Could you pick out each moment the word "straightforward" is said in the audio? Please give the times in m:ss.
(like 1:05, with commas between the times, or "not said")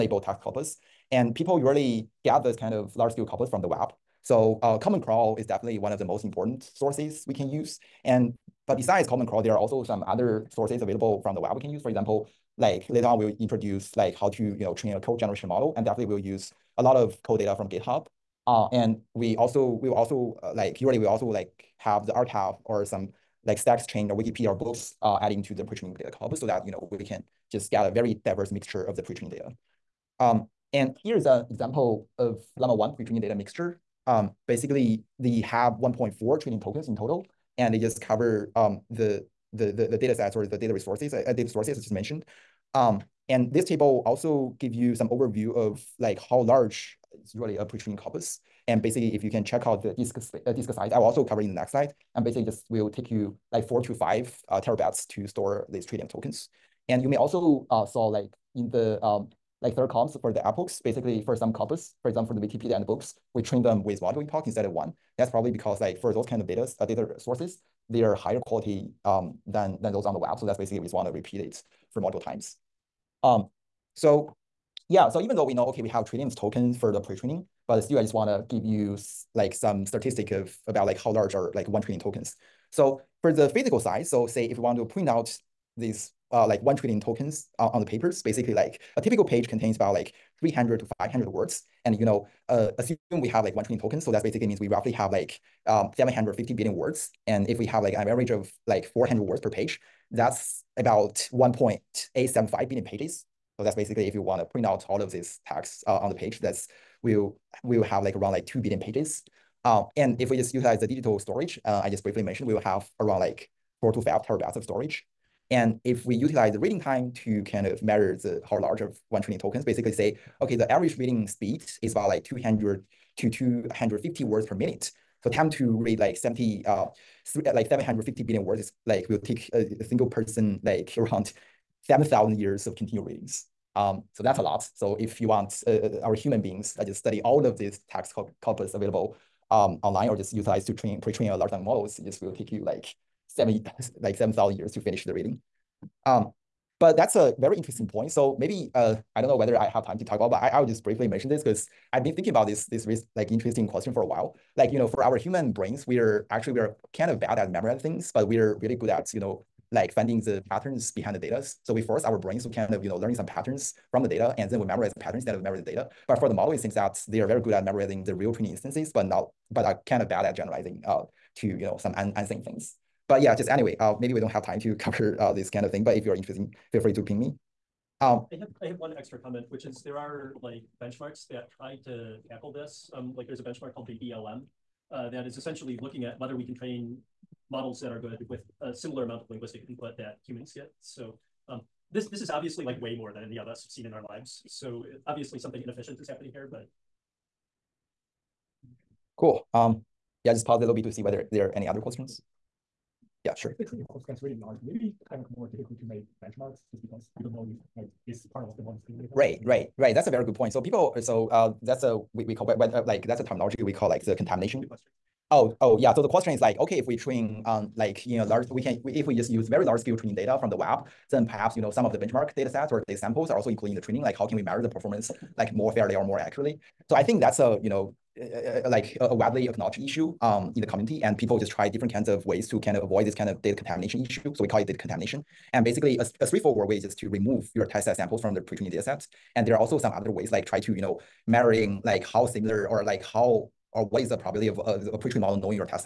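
3:56.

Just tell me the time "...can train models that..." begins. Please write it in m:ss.
3:06.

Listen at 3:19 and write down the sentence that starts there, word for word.
Um, yeah, just pause a little bit to see whether there are any other questions.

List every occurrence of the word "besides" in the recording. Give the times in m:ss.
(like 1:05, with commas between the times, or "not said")
0:08.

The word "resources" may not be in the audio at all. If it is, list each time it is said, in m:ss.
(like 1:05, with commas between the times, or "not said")
0:40.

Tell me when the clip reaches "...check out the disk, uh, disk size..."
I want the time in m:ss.
0:49.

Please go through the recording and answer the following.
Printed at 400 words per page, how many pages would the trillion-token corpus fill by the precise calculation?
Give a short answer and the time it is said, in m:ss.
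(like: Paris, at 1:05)
1.875 billion, at 1:41.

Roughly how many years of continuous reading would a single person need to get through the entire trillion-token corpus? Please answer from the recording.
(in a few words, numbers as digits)
7,000 years.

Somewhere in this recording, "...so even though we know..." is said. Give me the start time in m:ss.
1:15.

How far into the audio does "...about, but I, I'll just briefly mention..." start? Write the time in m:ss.
2:30.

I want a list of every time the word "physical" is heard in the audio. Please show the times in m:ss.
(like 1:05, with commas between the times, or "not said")
1:23.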